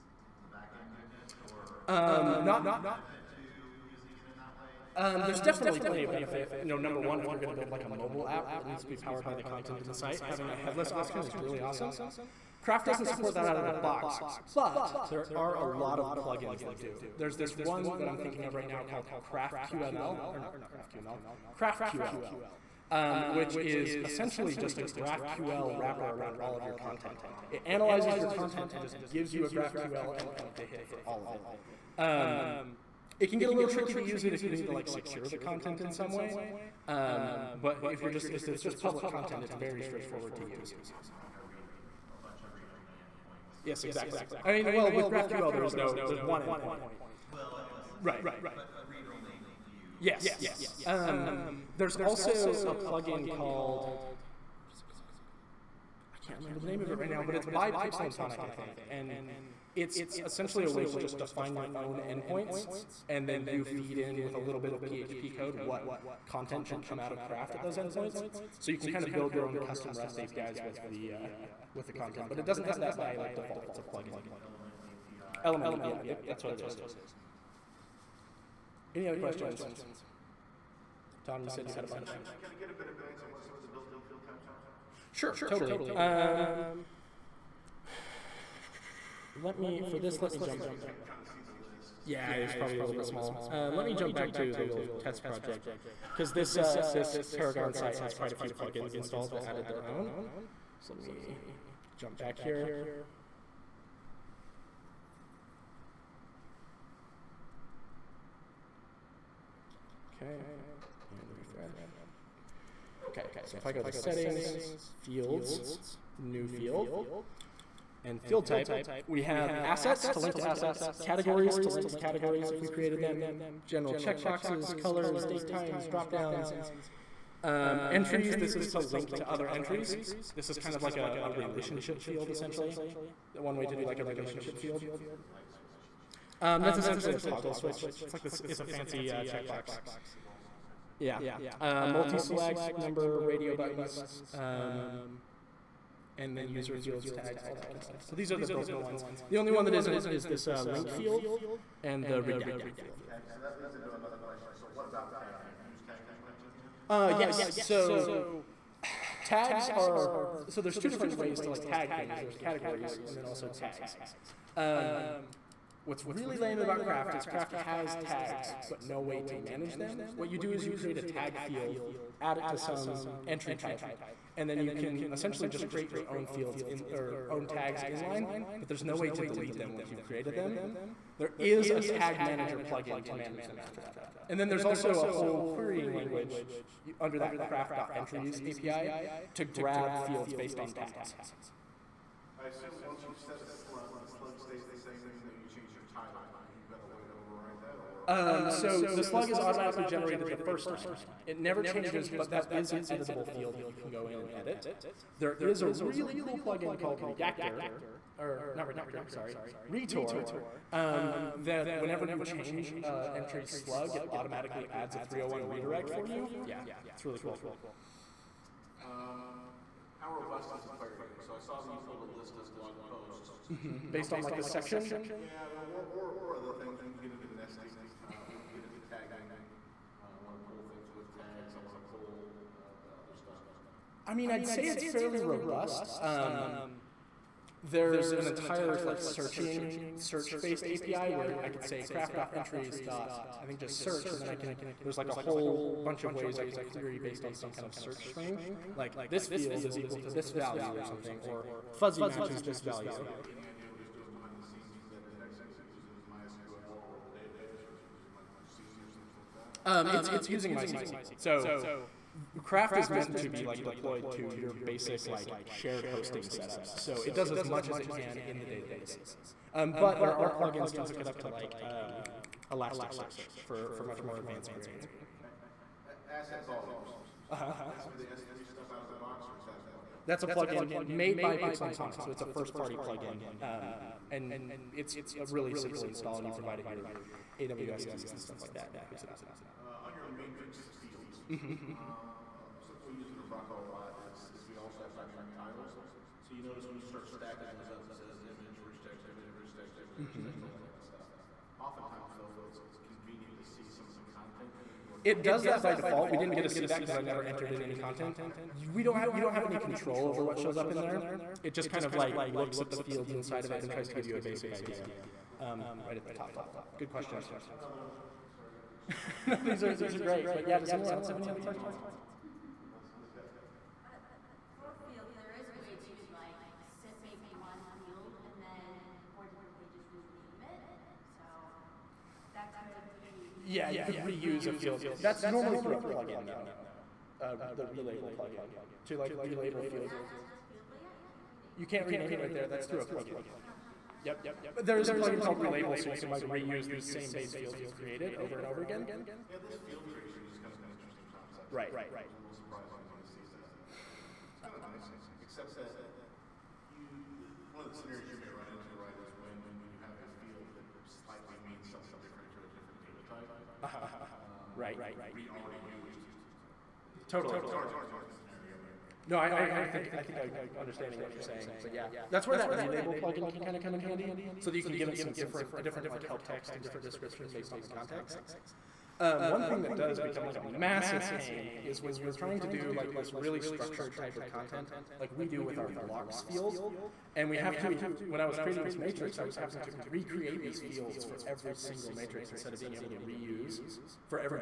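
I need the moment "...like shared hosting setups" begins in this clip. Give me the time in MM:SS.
04:25.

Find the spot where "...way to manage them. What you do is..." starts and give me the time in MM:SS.
02:49.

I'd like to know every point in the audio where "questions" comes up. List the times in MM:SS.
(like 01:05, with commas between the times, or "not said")
01:19, 02:34, 05:16, 05:21.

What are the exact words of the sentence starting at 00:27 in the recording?
Oh, it analyzes your content and just gives you a GraphQL endpoint to hit for all of it.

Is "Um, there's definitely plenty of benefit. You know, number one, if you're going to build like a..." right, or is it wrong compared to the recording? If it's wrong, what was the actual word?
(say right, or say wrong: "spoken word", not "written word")
right.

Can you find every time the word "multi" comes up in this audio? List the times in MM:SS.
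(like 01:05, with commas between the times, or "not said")
02:21.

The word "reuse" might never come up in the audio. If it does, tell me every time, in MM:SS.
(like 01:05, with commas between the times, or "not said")
05:34, 05:46, 06:33.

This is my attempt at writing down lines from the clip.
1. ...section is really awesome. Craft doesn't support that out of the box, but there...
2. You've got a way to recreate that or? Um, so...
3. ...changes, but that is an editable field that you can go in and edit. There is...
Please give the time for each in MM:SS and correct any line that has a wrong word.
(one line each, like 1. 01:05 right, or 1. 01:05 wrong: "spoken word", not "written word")
1. 00:10 wrong: "option", not "section"
2. 03:16 wrong: "overwrite", not "recreate"
3. 03:21 right.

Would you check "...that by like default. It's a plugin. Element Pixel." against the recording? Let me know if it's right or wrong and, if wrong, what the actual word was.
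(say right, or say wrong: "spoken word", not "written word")
wrong: "API", not "Pixel".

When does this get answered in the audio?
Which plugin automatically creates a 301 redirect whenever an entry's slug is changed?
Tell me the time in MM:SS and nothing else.
03:29.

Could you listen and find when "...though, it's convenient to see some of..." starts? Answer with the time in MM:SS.
05:02.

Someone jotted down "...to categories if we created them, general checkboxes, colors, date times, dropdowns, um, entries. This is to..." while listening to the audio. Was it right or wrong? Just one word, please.
right.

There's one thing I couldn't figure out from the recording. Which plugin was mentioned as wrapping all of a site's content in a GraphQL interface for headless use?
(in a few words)
Craft QL.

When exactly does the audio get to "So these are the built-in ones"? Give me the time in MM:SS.
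02:28.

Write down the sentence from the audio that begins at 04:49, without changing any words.
Uh, on your matrix field, Mm-hmm.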